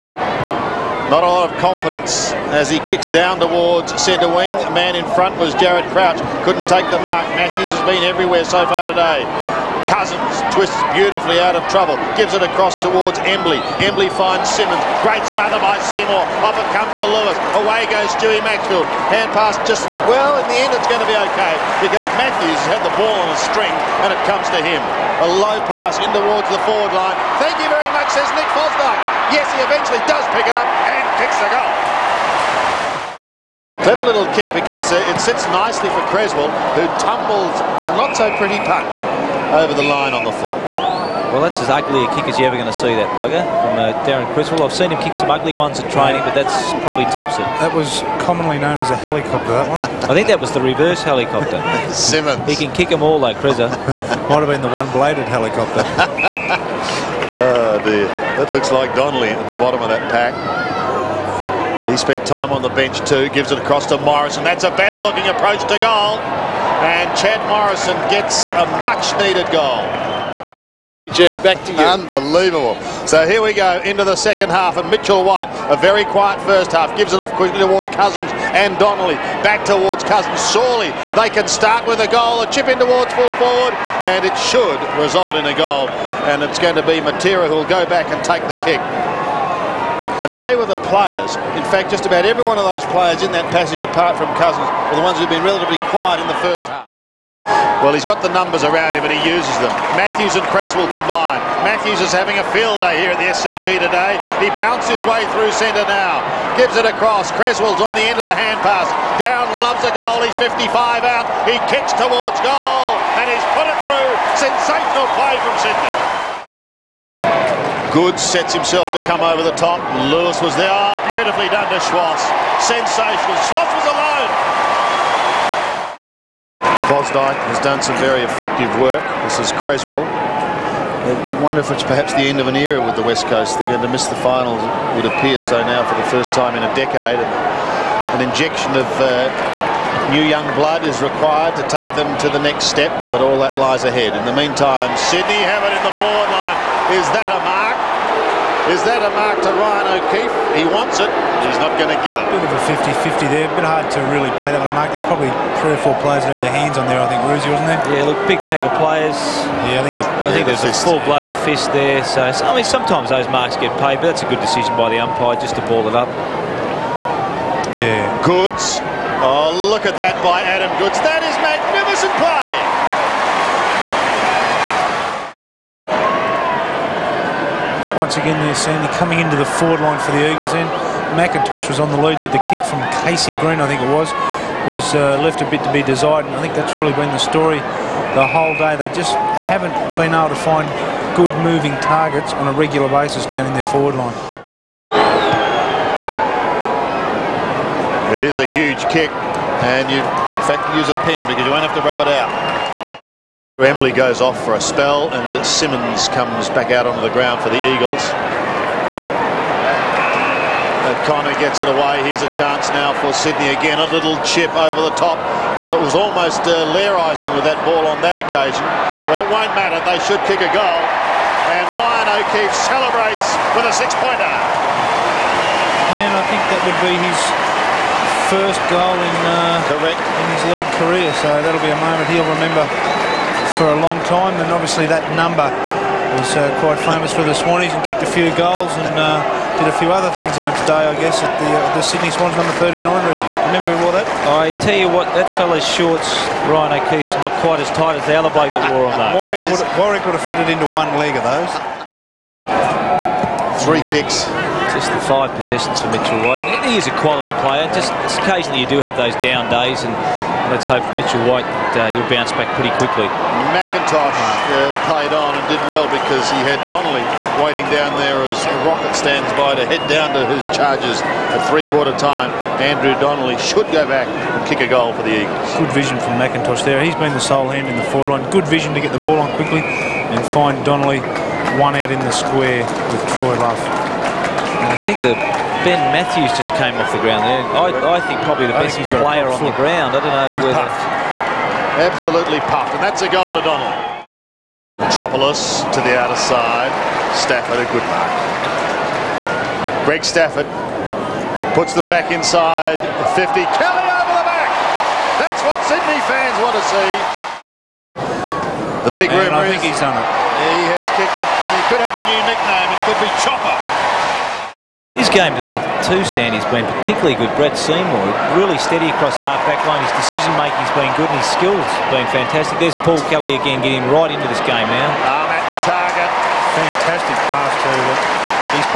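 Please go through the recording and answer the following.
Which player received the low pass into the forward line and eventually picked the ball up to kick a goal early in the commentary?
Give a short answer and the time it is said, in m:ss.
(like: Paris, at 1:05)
Nick Fosdike, at 0:28.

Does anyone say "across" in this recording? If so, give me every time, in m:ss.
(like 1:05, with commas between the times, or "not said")
0:12, 1:03, 1:46, 5:18.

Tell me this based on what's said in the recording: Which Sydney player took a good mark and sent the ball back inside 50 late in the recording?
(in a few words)
Greg Stafford.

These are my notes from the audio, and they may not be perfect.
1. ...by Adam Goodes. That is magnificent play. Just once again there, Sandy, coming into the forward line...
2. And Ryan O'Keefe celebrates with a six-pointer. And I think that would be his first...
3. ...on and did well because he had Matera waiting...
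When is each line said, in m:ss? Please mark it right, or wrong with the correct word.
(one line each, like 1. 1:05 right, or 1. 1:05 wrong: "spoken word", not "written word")
1. 2:50 right
2. 3:41 right
3. 4:25 wrong: "Donnelly", not "Matera".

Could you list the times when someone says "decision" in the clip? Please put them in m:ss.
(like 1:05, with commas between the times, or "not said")
2:44, 5:20.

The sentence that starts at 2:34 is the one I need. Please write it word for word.
There's probably three or four players that had their hands on there, I think, Ruzzi, wasn't there?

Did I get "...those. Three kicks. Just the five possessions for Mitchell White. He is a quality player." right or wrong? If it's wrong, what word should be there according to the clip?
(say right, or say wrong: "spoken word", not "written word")
right.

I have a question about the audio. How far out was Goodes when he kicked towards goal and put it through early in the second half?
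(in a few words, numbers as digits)
55.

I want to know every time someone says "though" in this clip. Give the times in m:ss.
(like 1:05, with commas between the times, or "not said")
0:53, 4:08.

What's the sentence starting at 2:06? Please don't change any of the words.
Fosdike has done some very effective work.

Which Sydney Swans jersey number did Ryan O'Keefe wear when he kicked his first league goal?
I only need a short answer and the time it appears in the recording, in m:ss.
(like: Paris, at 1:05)
39, at 4:02.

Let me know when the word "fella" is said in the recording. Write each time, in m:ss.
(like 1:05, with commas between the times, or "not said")
4:05.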